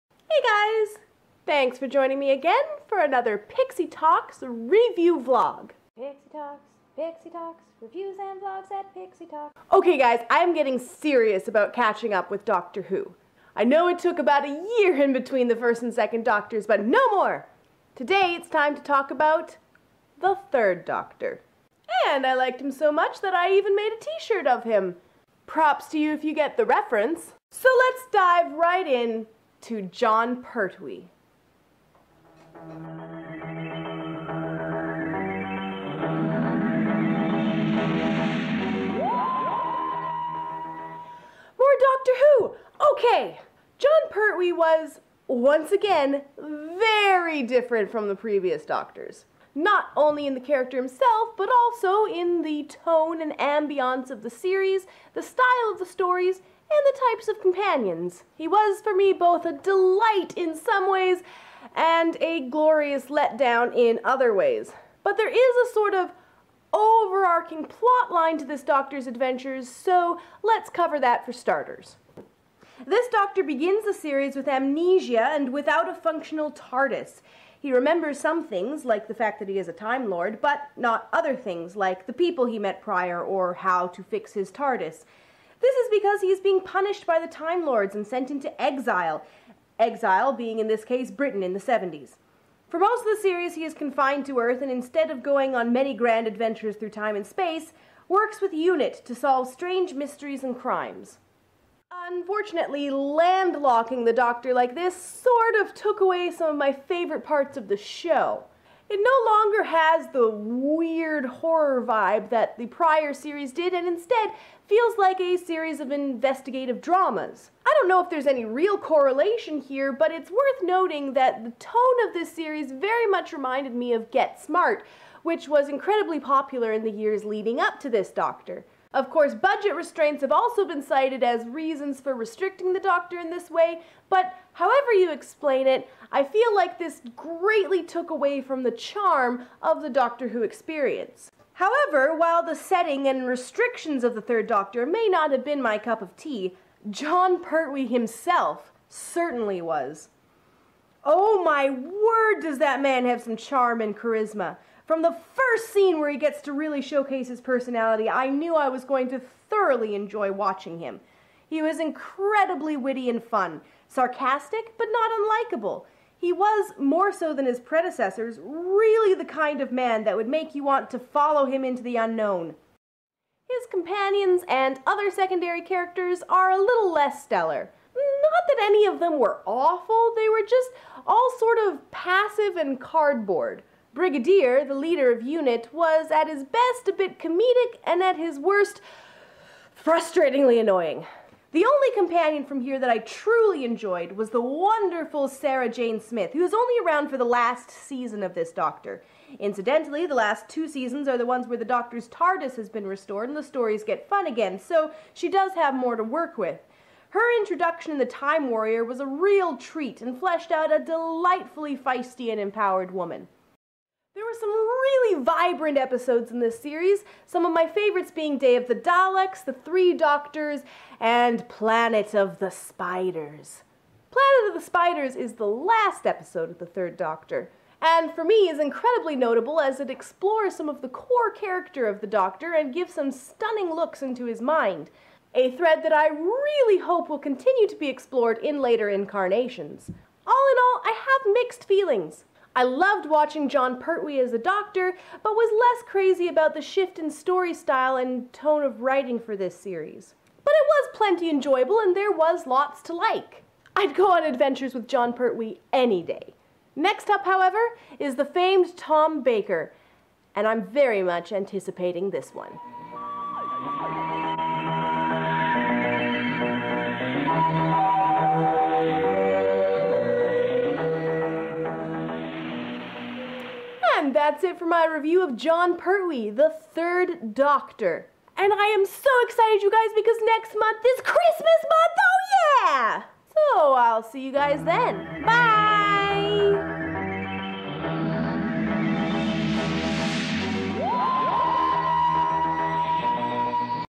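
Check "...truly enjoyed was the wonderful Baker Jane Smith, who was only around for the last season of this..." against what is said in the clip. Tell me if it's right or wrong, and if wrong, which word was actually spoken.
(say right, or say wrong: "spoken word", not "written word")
wrong: "Sarah", not "Baker".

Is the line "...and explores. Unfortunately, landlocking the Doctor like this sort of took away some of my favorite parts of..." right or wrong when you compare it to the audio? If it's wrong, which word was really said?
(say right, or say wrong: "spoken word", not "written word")
wrong: "crimes", not "explores".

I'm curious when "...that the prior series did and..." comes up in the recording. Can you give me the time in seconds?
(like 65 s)
112 s.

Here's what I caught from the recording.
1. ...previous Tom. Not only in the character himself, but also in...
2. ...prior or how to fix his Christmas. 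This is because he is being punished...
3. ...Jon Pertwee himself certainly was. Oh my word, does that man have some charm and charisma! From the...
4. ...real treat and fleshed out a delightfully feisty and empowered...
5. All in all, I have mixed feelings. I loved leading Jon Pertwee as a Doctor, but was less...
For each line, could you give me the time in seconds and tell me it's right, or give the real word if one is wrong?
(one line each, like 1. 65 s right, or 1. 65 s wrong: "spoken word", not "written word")
1. 48 s wrong: "Doctors", not "Tom"
2. 82 s wrong: "TARDIS", not "Christmas"
3. 146 s right
4. 209 s right
5. 240 s wrong: "watching", not "leading".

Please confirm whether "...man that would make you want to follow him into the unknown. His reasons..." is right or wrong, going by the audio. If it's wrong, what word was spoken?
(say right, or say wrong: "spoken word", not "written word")
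wrong: "companions", not "reasons".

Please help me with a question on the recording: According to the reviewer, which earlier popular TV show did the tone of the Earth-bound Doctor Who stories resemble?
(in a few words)
Get Smart.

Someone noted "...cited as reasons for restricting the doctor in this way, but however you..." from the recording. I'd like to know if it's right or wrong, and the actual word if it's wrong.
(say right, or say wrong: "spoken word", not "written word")
right.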